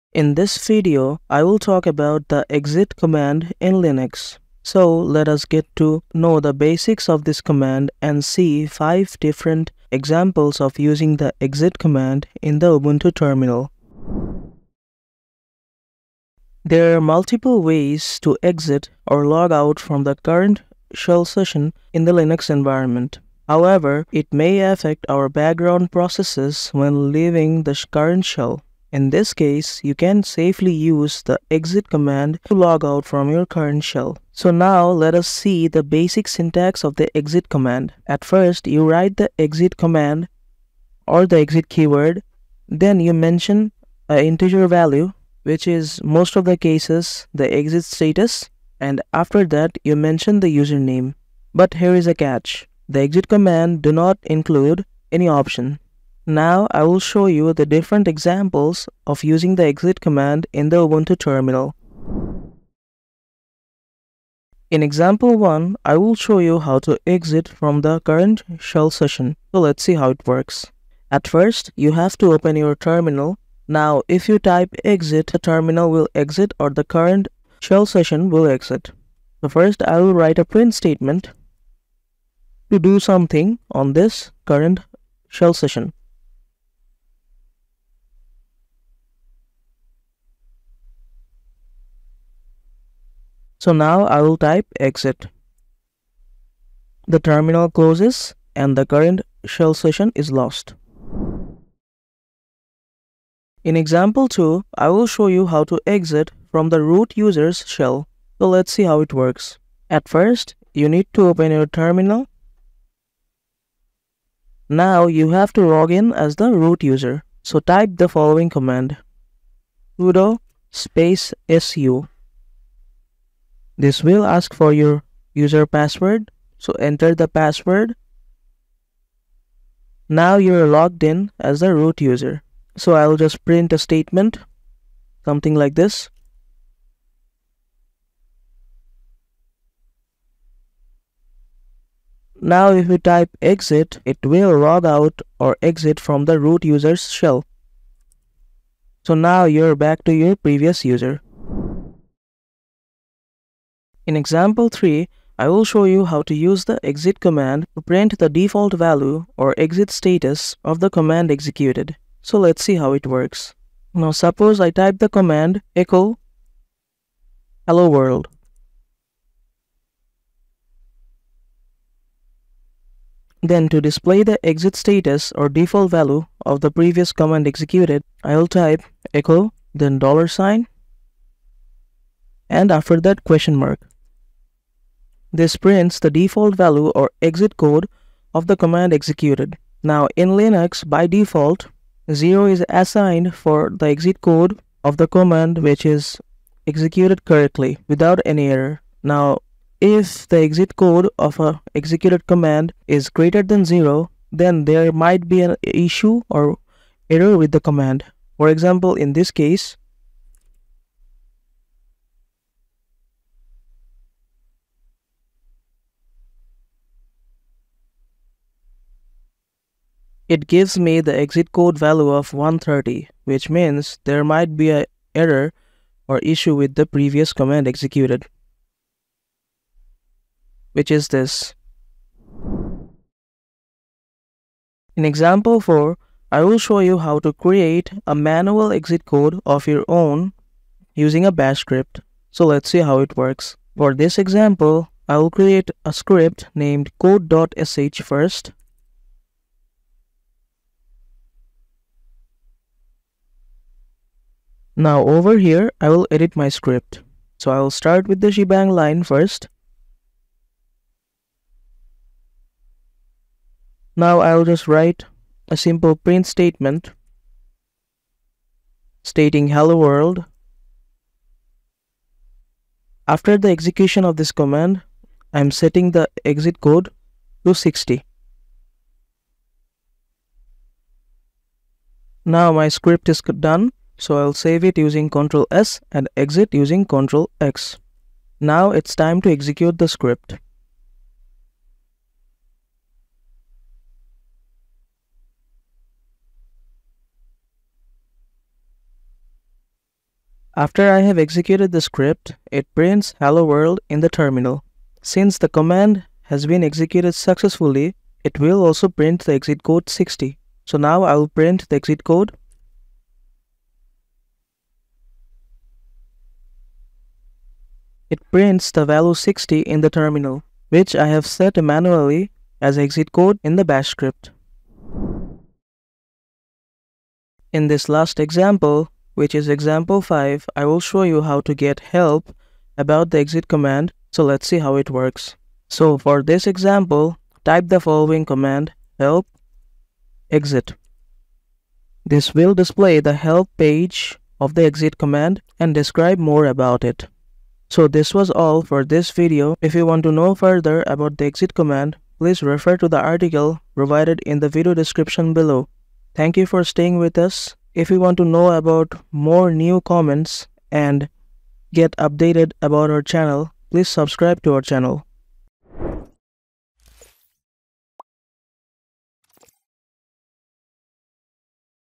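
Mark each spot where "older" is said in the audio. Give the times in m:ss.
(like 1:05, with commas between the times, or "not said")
not said.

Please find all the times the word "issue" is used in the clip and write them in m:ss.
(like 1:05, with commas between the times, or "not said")
3:25, 3:46.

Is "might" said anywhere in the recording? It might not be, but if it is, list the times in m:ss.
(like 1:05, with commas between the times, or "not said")
3:24, 3:44.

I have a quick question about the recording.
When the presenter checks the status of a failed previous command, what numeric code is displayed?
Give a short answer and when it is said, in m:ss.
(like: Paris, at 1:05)
130, at 3:42.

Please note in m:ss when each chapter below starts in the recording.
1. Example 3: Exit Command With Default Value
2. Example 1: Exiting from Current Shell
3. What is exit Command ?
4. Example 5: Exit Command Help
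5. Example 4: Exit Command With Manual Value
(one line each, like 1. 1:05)
1. 2:32
2. 1:04
3. 0:15
4. 5:25
5. 3:54.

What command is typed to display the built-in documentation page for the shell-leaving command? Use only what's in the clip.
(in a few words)
help exit.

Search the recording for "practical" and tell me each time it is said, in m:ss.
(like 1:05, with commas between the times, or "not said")
not said.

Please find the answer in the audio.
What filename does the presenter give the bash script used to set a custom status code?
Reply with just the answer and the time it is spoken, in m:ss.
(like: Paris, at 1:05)
code.sh, at 4:07.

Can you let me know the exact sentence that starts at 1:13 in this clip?
Now, if you type exit, the terminal will exit or the current shell session will exit.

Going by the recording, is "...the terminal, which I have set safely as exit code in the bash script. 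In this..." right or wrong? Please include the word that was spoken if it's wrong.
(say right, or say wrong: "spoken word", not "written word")
wrong: "manually", not "safely".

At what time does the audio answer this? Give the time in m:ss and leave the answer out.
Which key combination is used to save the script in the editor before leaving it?
4:45.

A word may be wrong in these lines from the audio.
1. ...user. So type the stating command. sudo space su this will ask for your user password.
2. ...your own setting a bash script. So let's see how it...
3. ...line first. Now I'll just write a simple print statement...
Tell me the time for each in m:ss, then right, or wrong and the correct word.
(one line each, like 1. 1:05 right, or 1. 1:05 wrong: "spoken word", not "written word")
1. 1:56 wrong: "following", not "stating"
2. 3:59 wrong: "using", not "setting"
3. 4:18 right.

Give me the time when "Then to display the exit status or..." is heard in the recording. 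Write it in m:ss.
2:53.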